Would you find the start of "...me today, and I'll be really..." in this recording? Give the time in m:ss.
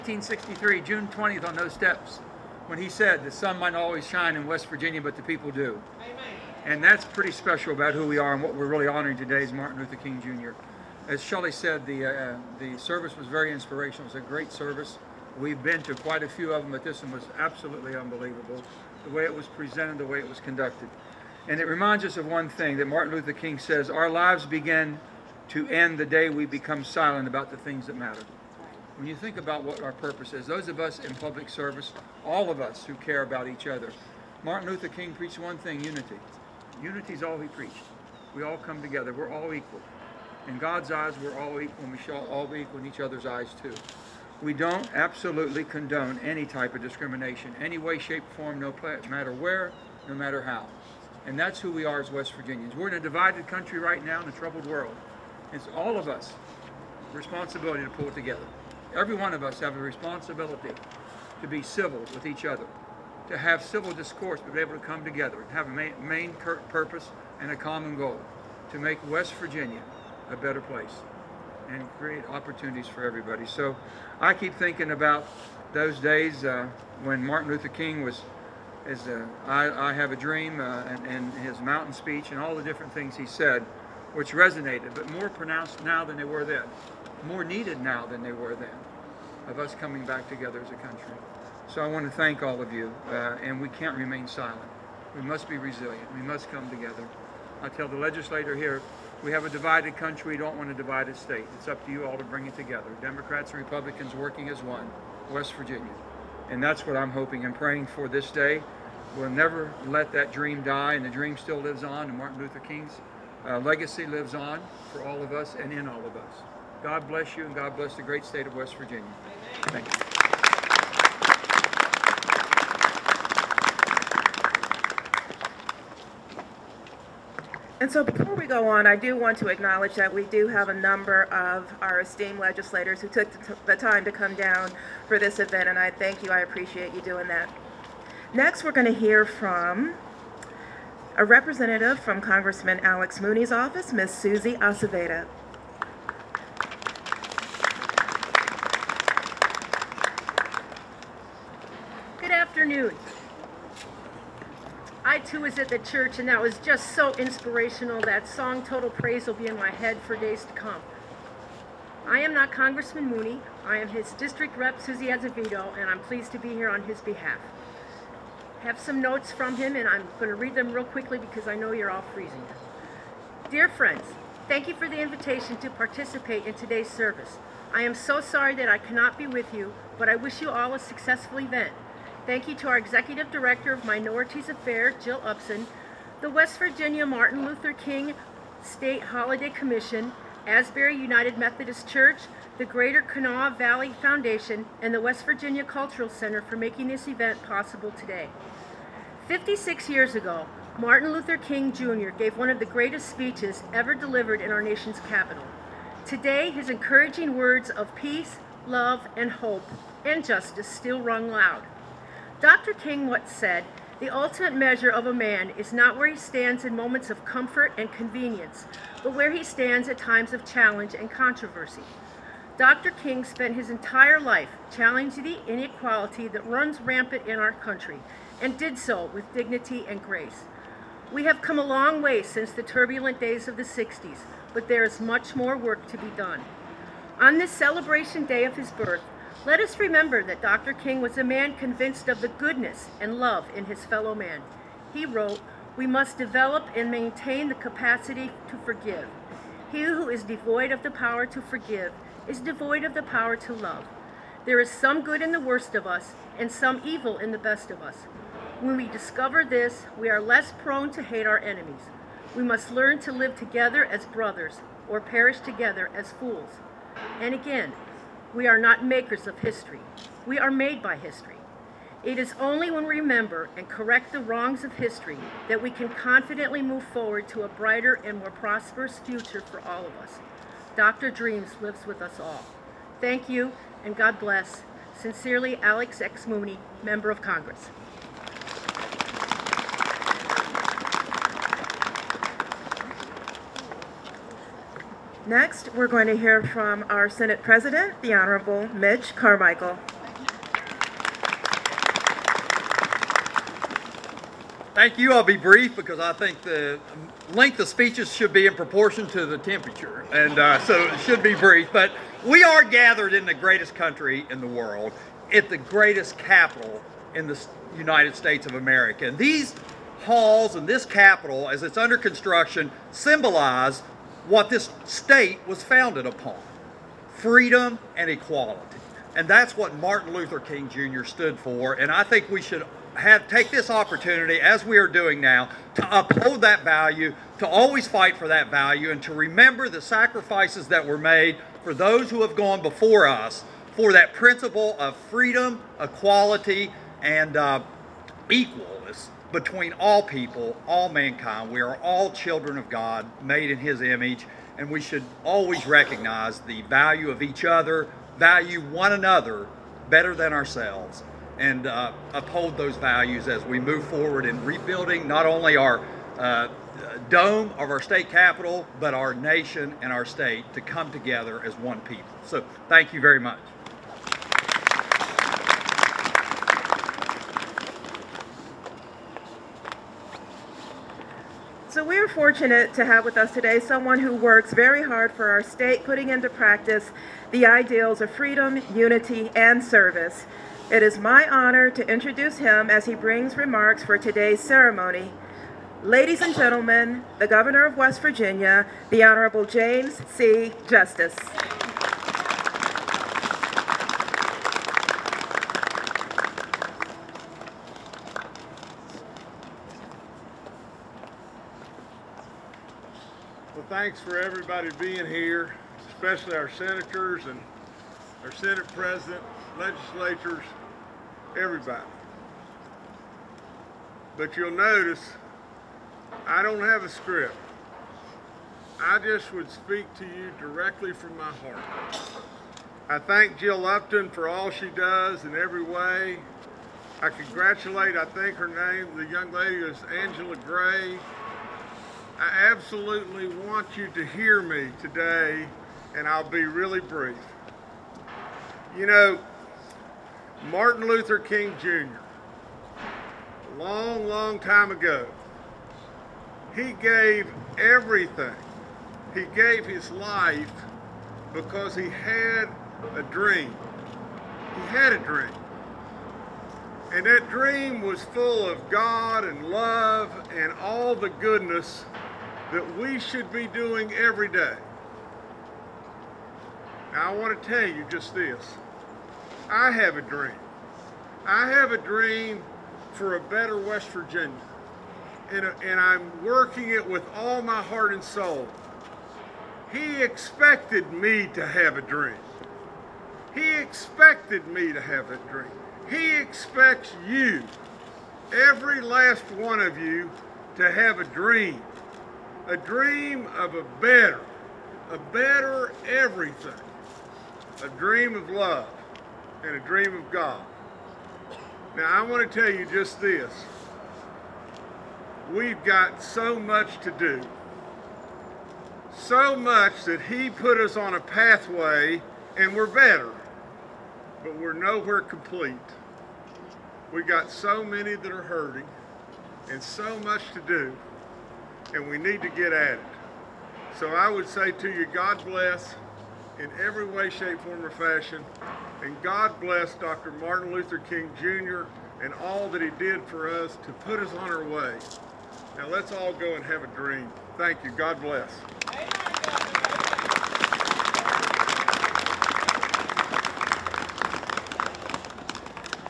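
7:24.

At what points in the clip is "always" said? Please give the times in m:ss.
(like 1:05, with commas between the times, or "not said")
0:03, 5:37, 5:55.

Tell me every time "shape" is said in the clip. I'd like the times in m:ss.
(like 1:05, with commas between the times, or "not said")
0:47, 8:57.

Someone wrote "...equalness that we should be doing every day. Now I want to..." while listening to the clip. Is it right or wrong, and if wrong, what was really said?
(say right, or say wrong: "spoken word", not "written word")
wrong: "goodness", not "equalness".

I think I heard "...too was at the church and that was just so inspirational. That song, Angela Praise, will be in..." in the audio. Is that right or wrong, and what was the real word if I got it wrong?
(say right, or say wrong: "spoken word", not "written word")
wrong: "Total", not "Angela".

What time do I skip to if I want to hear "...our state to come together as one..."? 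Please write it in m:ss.
6:09.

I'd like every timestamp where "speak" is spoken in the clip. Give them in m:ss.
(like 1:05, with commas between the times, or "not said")
7:09.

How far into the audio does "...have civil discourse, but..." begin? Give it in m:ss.
1:03.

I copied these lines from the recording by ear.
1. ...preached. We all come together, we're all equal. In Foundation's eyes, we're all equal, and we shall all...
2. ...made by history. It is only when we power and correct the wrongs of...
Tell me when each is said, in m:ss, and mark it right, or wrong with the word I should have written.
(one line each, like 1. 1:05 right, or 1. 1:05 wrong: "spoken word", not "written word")
1. 0:37 wrong: "God", not "Foundation"
2. 4:30 wrong: "remember", not "power".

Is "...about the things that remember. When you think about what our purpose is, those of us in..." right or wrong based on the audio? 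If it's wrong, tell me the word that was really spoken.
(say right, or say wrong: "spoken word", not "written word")
wrong: "matter", not "remember".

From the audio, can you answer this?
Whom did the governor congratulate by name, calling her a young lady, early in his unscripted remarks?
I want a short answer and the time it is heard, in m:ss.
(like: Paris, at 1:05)
Angela Gray, at 7:20.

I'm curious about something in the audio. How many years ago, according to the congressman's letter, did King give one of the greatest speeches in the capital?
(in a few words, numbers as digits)
56.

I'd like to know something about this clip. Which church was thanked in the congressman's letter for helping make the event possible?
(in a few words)
Asbury United Methodist Church.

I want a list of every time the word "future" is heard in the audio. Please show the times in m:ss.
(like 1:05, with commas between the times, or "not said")
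4:38.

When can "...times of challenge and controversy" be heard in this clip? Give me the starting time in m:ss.
3:39.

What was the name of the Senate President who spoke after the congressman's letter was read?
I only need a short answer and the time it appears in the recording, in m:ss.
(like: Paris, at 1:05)
Mitch Carmichael, at 4:58.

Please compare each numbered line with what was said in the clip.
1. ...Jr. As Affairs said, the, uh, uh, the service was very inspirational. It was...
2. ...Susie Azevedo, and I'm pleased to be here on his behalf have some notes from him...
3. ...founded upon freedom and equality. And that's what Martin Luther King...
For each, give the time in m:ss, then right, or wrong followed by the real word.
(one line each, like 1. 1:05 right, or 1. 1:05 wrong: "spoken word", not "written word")
1. 0:10 wrong: "Shelley", not "Affairs"
2. 2:44 right
3. 5:25 right.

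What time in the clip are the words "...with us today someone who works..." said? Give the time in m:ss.
6:23.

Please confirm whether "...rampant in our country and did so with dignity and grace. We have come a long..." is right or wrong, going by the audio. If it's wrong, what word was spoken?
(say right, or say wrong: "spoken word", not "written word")
right.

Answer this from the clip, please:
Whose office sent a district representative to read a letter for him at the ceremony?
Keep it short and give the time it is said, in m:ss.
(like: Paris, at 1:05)
Alex Mooney, at 2:22.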